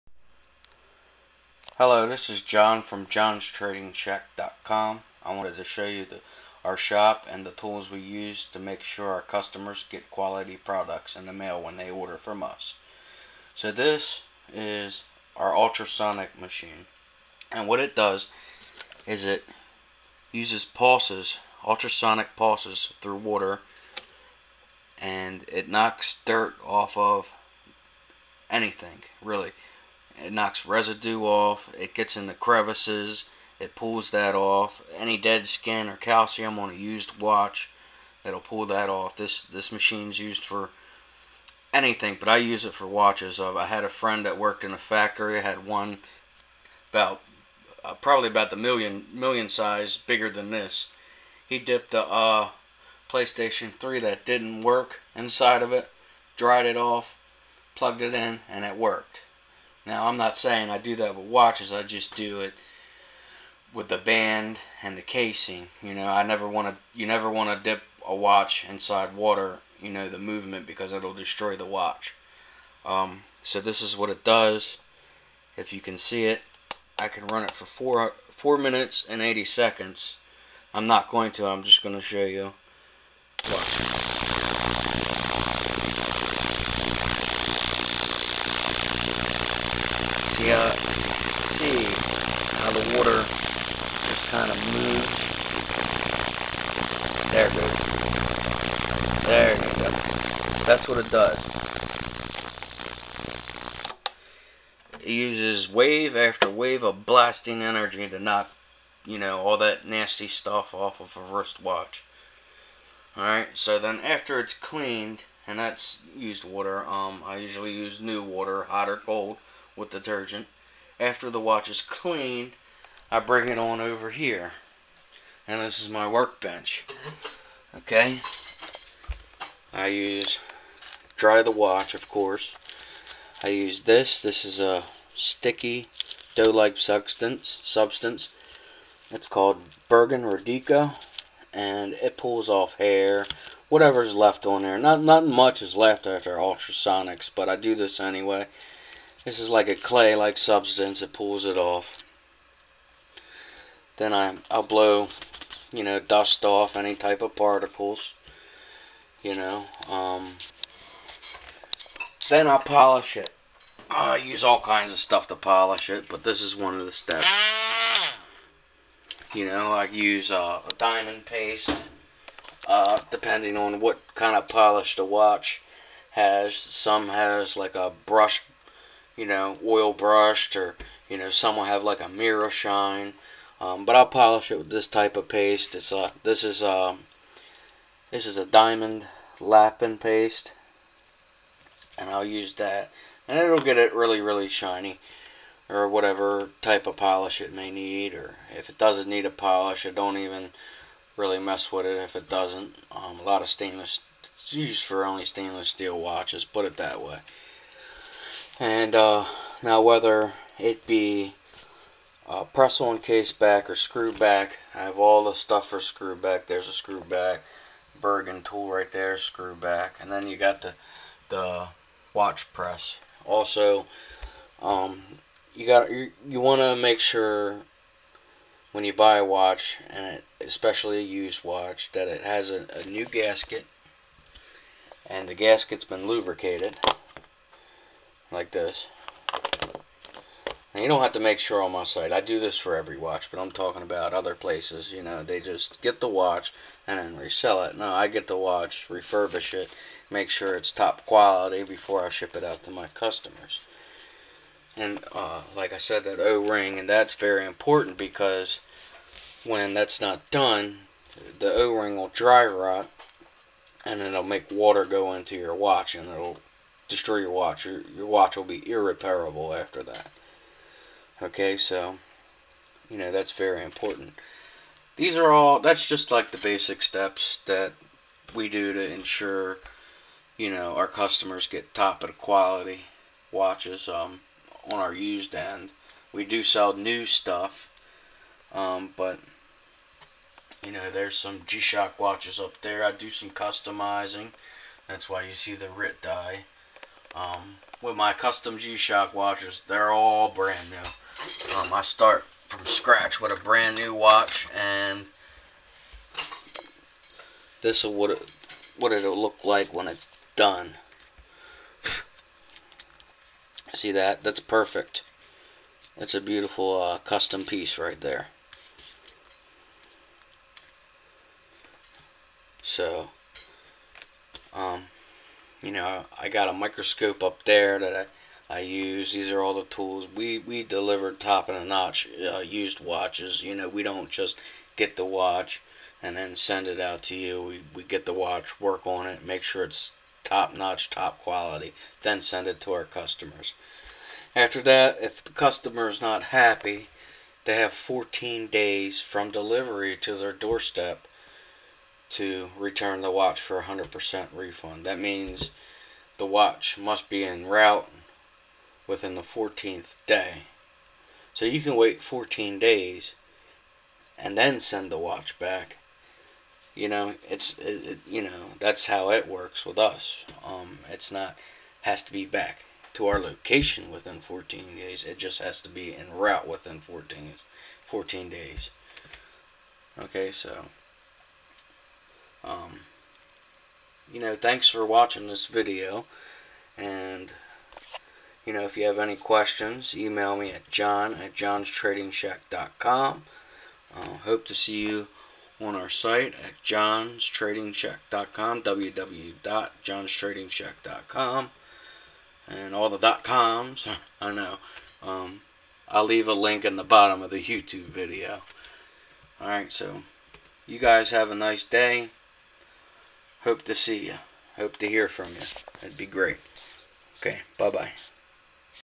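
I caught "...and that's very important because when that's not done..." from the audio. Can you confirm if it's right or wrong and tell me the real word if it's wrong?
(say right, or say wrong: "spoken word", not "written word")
right.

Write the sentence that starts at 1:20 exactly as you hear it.
I'm not going to, I'm just going to show you.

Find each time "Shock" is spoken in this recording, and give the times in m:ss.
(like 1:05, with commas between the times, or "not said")
4:51, 4:58.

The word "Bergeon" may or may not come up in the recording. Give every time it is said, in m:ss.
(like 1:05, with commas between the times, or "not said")
2:19, 3:37.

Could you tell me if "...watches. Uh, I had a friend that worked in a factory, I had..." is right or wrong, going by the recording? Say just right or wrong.
right.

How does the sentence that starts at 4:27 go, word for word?
Your, your watch will be irreparable after that.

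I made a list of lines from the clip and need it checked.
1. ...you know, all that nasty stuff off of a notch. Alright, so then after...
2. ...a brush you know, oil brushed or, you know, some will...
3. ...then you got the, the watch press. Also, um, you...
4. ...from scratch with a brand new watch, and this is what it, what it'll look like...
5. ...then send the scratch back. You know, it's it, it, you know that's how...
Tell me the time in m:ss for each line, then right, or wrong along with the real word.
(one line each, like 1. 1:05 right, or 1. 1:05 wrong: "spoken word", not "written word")
1. 1:49 wrong: "wristwatch", not "notch"
2. 2:57 right
3. 3:40 right
4. 5:02 right
5. 6:04 wrong: "watch", not "scratch".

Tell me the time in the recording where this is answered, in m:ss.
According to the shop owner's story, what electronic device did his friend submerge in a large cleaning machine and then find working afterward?
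0:53.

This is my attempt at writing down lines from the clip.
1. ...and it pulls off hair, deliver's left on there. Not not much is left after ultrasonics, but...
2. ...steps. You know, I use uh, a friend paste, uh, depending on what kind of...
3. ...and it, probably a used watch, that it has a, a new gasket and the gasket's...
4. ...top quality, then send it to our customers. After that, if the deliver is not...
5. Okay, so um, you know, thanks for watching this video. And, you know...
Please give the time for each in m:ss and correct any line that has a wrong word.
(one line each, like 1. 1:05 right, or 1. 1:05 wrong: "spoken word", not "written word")
1. 2:21 wrong: "whatever", not "deliver"
2. 2:46 wrong: "diamond", not "friend"
3. 3:49 wrong: "especially", not "probably"
4. 5:40 wrong: "customer", not "deliver"
5. 6:19 right.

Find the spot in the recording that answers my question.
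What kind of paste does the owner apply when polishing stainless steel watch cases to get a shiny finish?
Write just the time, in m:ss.
3:08.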